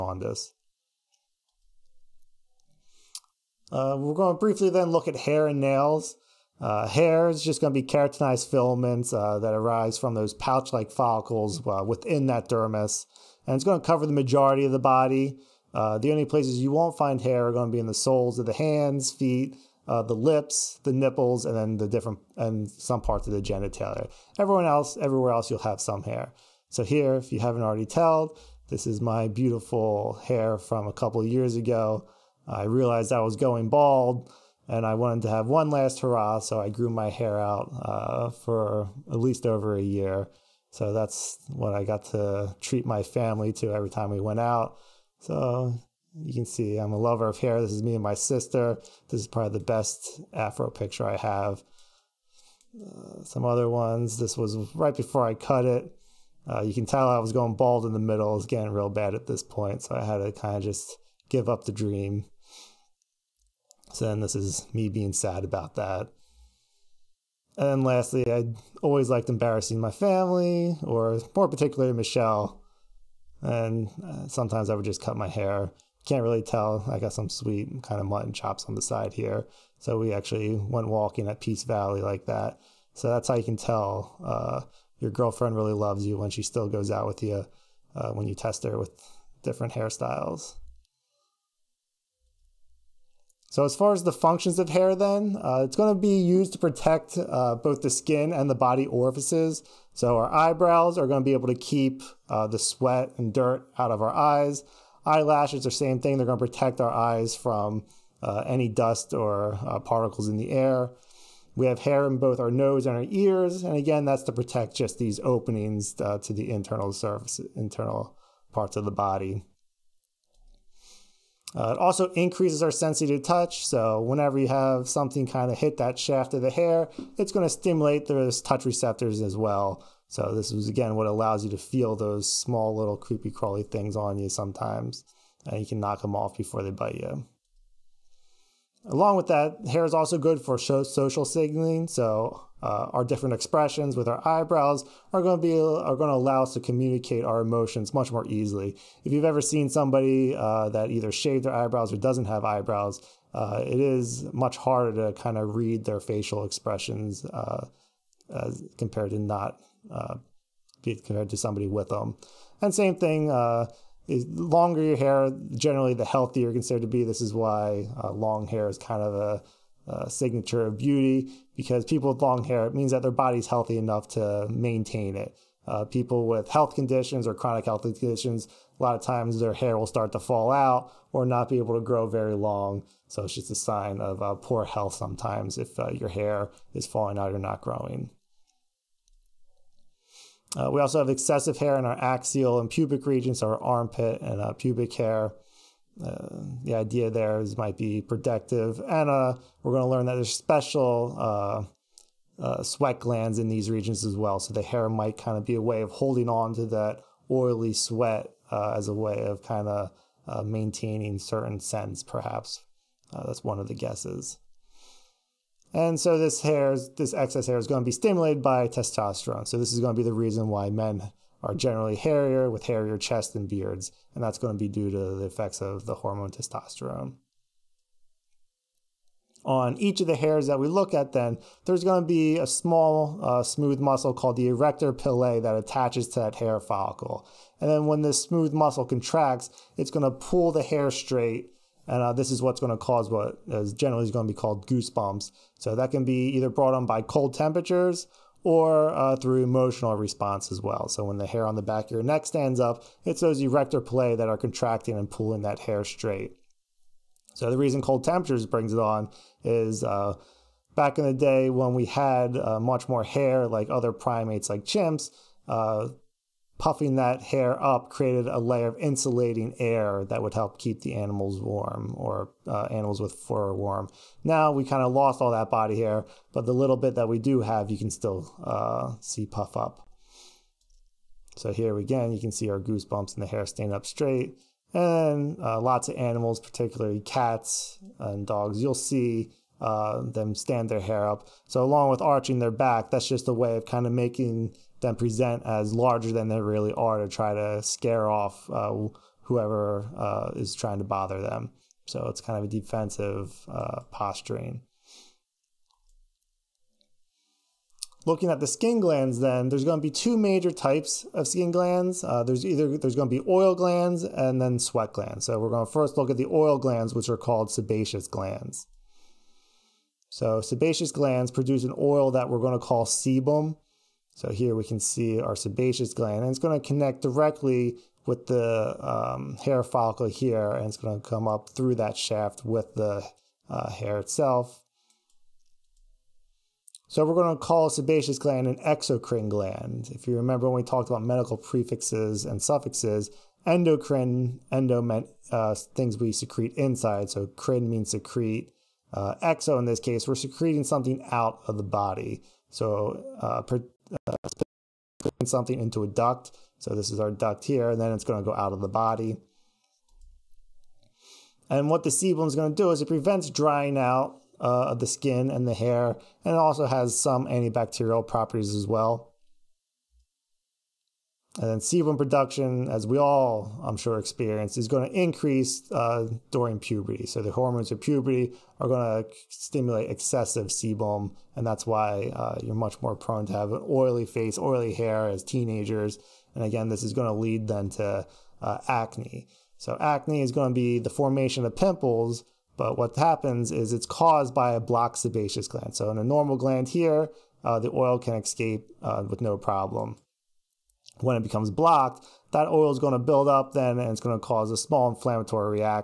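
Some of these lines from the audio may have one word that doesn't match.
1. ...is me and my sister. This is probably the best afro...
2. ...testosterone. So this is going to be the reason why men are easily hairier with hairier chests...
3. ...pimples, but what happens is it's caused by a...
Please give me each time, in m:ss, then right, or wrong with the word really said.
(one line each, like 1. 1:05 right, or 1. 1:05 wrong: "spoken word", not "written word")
1. 0:47 right
2. 3:38 wrong: "generally", not "easily"
3. 6:31 right.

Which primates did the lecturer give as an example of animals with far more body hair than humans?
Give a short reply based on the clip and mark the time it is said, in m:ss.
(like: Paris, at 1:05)
chimps, at 4:24.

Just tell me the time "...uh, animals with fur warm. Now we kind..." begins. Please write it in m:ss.
4:32.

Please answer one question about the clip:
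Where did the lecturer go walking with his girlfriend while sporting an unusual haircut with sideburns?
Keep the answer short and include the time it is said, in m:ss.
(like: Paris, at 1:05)
Peace Valley, at 1:21.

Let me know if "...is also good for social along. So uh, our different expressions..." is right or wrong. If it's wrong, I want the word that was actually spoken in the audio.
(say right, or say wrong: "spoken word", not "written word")
wrong: "signaling", not "along".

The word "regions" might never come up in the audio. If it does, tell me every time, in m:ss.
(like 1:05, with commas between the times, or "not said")
3:13, 3:23.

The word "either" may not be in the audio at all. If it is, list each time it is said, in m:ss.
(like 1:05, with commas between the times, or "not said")
2:30, 4:06, 5:12.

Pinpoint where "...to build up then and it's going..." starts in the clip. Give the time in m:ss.
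6:42.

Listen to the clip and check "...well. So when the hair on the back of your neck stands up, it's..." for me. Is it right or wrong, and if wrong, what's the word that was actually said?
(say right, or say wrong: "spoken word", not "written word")
right.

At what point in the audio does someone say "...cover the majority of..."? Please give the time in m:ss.
0:13.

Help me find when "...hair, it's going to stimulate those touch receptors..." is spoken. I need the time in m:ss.
2:06.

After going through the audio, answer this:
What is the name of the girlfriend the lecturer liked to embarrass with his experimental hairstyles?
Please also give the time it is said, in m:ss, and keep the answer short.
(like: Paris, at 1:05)
Michelle, at 1:11.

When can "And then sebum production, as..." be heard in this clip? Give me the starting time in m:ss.
6:11.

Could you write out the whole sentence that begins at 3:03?
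So it's just a sign of uh, poor health sometimes if uh, your hair is falling out or not growing.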